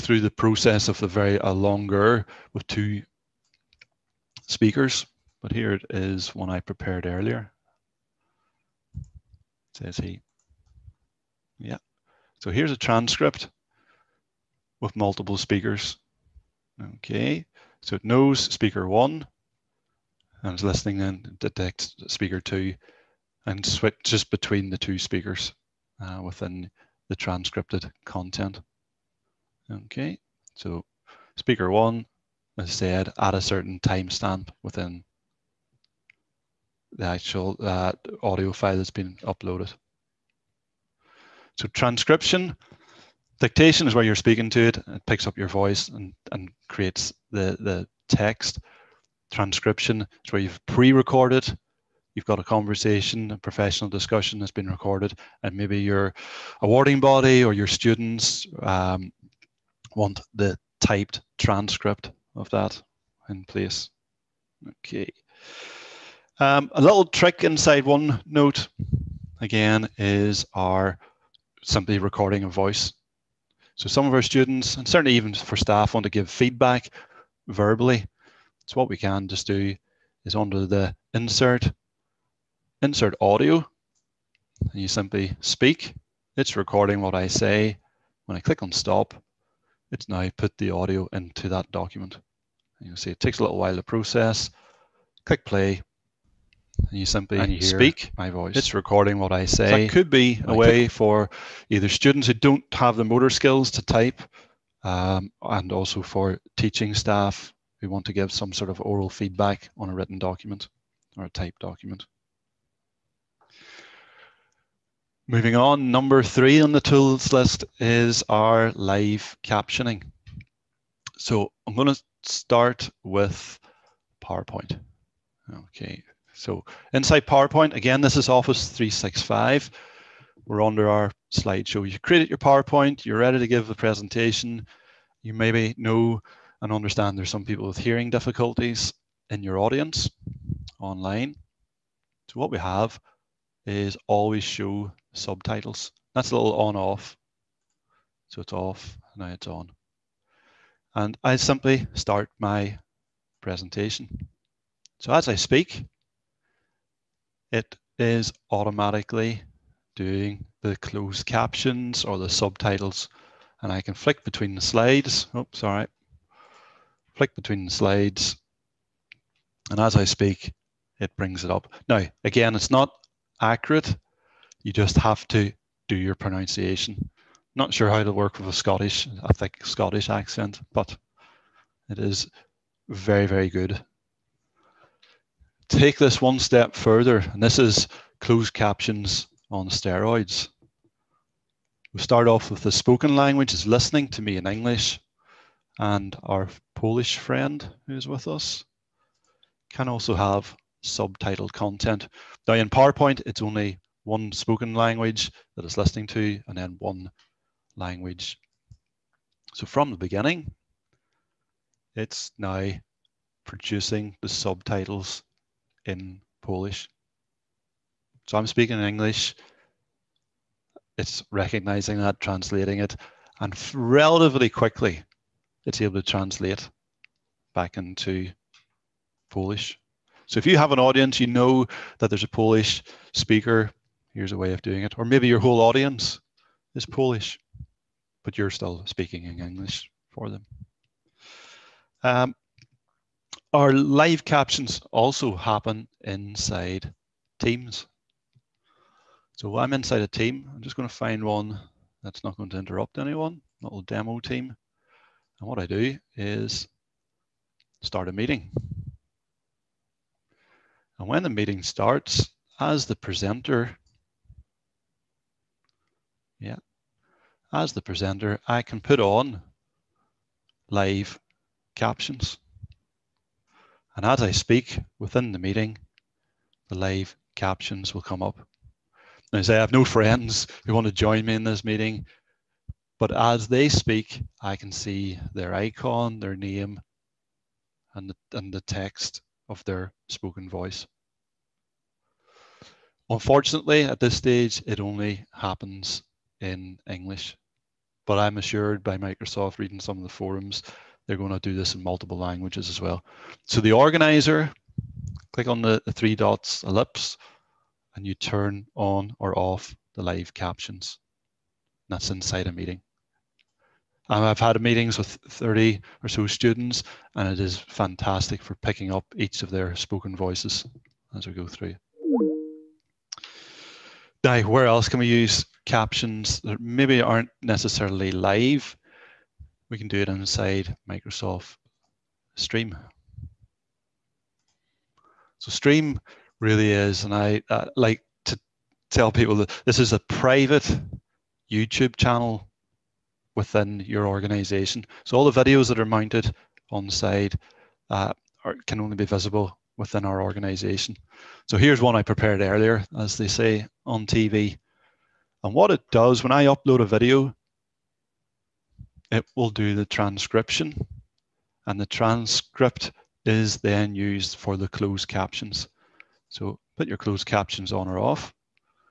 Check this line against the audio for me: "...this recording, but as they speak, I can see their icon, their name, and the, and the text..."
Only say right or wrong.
wrong.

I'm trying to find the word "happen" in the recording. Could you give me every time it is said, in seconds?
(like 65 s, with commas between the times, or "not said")
245 s, 295 s.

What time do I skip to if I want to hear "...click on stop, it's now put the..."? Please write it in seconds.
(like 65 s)
88 s.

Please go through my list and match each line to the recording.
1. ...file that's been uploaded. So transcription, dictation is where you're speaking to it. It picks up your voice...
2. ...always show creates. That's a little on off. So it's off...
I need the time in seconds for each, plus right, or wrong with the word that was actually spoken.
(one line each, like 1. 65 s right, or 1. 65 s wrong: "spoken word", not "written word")
1. 38 s right
2. 144 s wrong: "subtitles", not "creates".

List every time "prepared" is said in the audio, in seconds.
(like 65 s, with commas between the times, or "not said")
6 s, 352 s.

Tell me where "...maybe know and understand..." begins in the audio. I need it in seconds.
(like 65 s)
135 s.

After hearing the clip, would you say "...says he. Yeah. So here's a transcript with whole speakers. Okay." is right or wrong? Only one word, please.
wrong.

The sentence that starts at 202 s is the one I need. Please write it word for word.
Now in PowerPoint, it's only one spoken language that is listening to, and then one language.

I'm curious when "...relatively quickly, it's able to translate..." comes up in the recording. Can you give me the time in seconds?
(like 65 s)
223 s.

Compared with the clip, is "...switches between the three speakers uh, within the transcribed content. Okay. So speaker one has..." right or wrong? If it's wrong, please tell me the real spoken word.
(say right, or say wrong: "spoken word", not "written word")
wrong: "two", not "three".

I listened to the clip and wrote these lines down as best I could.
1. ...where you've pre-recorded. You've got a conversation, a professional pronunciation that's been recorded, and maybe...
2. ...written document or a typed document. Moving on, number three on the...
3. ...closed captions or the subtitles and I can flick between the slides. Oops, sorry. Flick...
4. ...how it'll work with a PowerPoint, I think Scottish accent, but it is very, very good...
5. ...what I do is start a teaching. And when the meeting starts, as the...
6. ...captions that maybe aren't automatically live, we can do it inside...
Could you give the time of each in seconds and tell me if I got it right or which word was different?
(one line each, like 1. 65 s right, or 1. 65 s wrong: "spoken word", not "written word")
1. 50 s wrong: "discussion", not "pronunciation"
2. 109 s right
3. 160 s right
4. 177 s wrong: "Scottish", not "PowerPoint"
5. 255 s wrong: "meeting", not "teaching"
6. 325 s wrong: "necessarily", not "automatically".